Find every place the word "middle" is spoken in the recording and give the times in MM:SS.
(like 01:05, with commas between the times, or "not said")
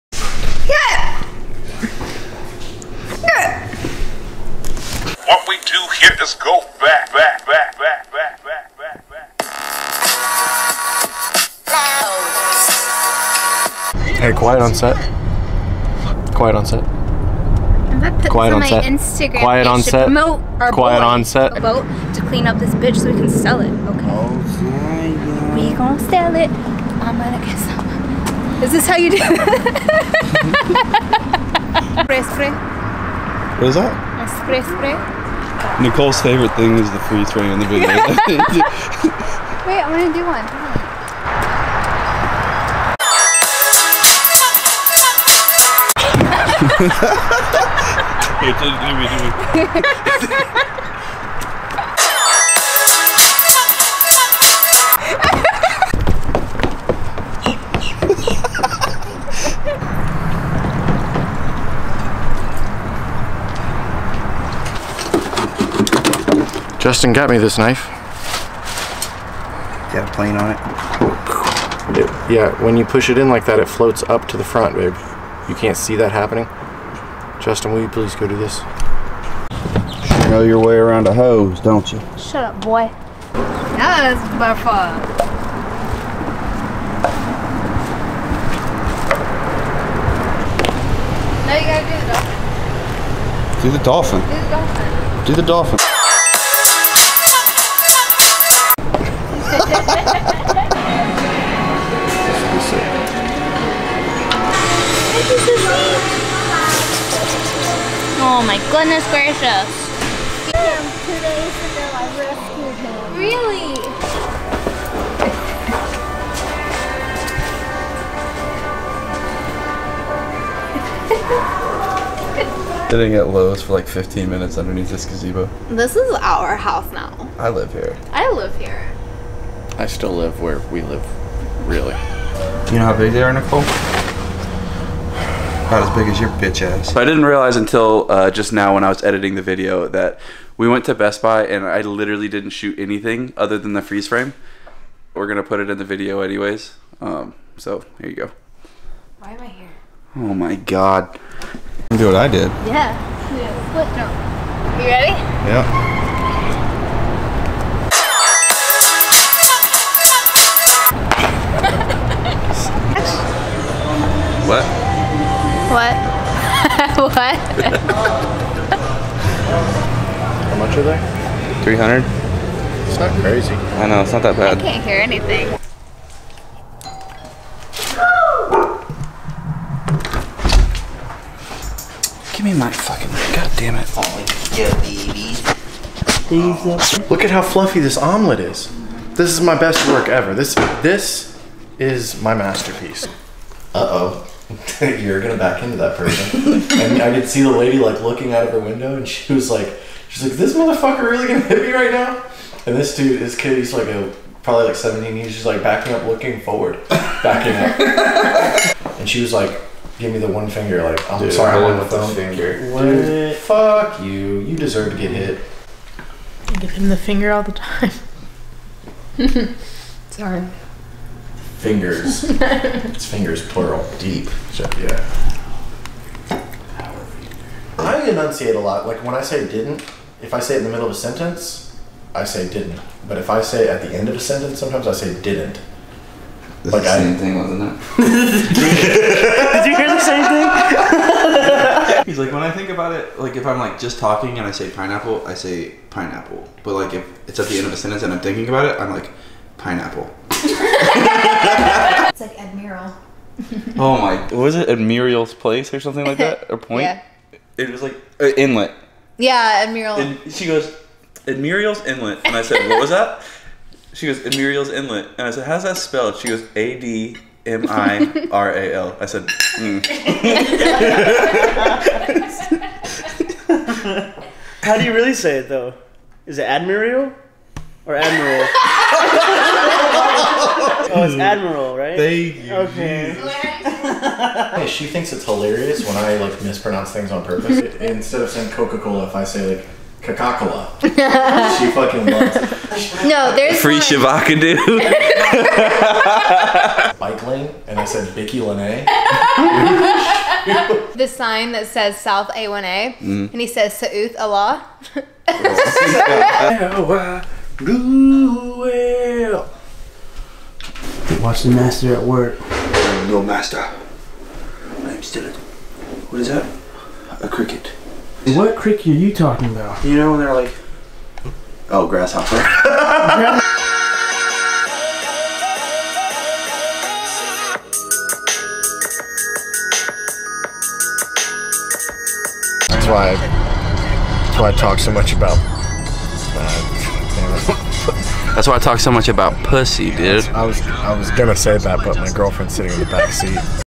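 03:50.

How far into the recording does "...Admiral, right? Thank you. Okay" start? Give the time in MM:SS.
04:41.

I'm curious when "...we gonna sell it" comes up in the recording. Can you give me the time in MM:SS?
00:25.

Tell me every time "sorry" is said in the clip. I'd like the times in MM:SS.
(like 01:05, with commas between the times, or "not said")
03:31, 03:40.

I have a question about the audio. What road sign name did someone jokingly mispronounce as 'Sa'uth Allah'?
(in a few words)
South A1A.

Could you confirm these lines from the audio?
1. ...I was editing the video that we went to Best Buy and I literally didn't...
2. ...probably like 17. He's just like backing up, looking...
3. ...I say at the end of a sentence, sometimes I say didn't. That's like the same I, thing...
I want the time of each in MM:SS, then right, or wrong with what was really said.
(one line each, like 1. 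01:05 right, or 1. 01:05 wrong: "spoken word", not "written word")
1. 02:18 right
2. 03:24 right
3. 03:53 right.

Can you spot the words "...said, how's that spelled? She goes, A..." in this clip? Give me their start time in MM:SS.
04:25.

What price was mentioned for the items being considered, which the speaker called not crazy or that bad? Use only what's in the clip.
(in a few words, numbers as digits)
300.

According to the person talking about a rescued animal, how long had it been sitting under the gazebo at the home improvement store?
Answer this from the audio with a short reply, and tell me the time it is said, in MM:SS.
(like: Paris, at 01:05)
15 minutes, at 02:03.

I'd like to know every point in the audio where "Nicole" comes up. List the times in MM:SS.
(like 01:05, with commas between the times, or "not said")
00:35, 02:13.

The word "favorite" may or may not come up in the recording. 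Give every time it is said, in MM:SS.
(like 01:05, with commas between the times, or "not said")
00:36.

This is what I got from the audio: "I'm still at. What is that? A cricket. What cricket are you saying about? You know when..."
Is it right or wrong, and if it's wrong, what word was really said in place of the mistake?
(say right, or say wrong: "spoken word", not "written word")
wrong: "talking", not "saying".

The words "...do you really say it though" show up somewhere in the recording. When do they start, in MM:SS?
04:34.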